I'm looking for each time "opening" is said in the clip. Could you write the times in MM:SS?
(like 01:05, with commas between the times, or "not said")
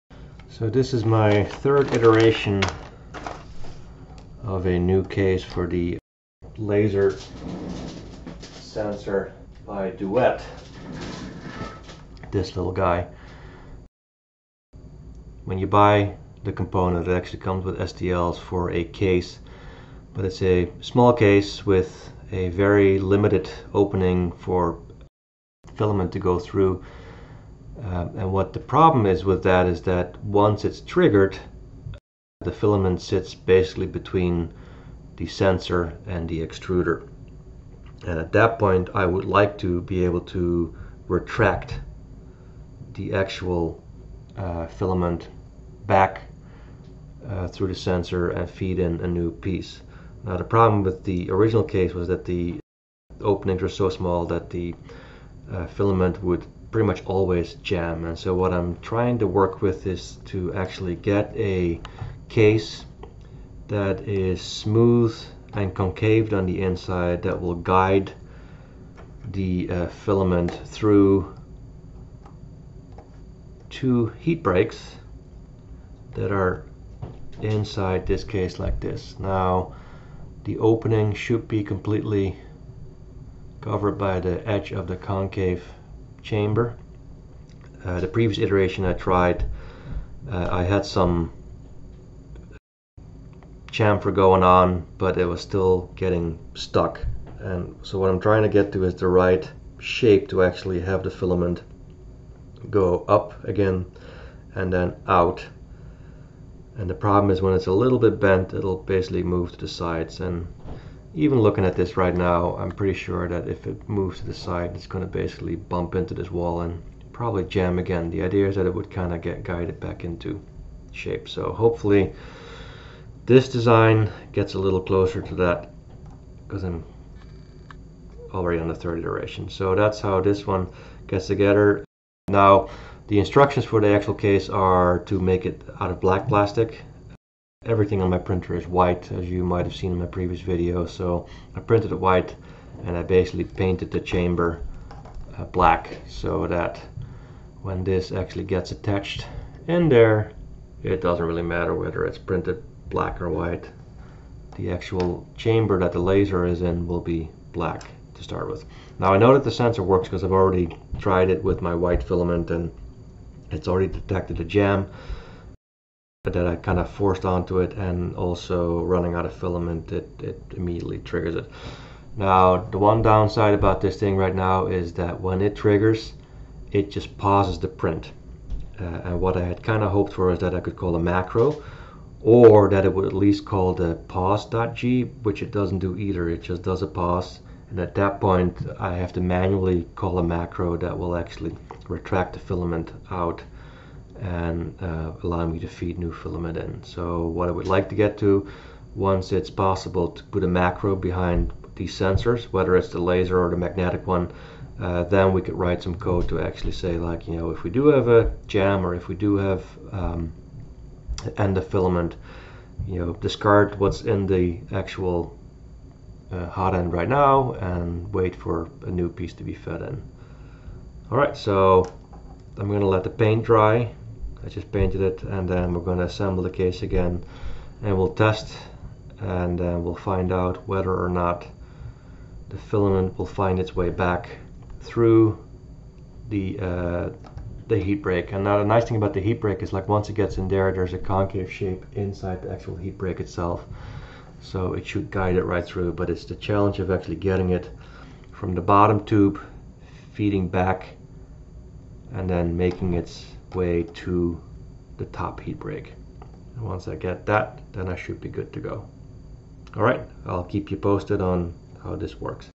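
00:23, 00:53, 01:20.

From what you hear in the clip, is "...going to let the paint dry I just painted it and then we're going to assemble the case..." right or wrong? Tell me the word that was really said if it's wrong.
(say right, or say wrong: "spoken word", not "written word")
right.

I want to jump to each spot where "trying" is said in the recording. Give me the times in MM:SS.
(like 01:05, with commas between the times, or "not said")
00:58, 01:38.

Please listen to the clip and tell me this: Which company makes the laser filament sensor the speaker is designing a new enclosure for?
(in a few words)
Duet.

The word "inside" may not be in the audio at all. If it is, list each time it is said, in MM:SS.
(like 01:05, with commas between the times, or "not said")
01:06, 01:17, 04:01.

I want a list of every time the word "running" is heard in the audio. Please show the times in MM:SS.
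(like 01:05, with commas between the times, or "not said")
02:48.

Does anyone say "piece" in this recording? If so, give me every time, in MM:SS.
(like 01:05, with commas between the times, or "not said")
00:49, 03:39.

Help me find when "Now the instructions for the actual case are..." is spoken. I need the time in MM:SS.
02:12.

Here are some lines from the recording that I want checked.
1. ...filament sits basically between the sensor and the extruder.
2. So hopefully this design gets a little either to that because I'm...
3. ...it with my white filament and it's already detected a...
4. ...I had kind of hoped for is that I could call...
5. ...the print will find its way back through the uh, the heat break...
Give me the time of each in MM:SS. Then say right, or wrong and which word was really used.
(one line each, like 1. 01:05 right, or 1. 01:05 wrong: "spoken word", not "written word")
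1. 00:32 right
2. 02:01 wrong: "closer", not "either"
3. 02:41 right
4. 02:59 right
5. 03:52 wrong: "filament", not "print".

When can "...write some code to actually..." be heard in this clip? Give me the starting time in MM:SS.
03:25.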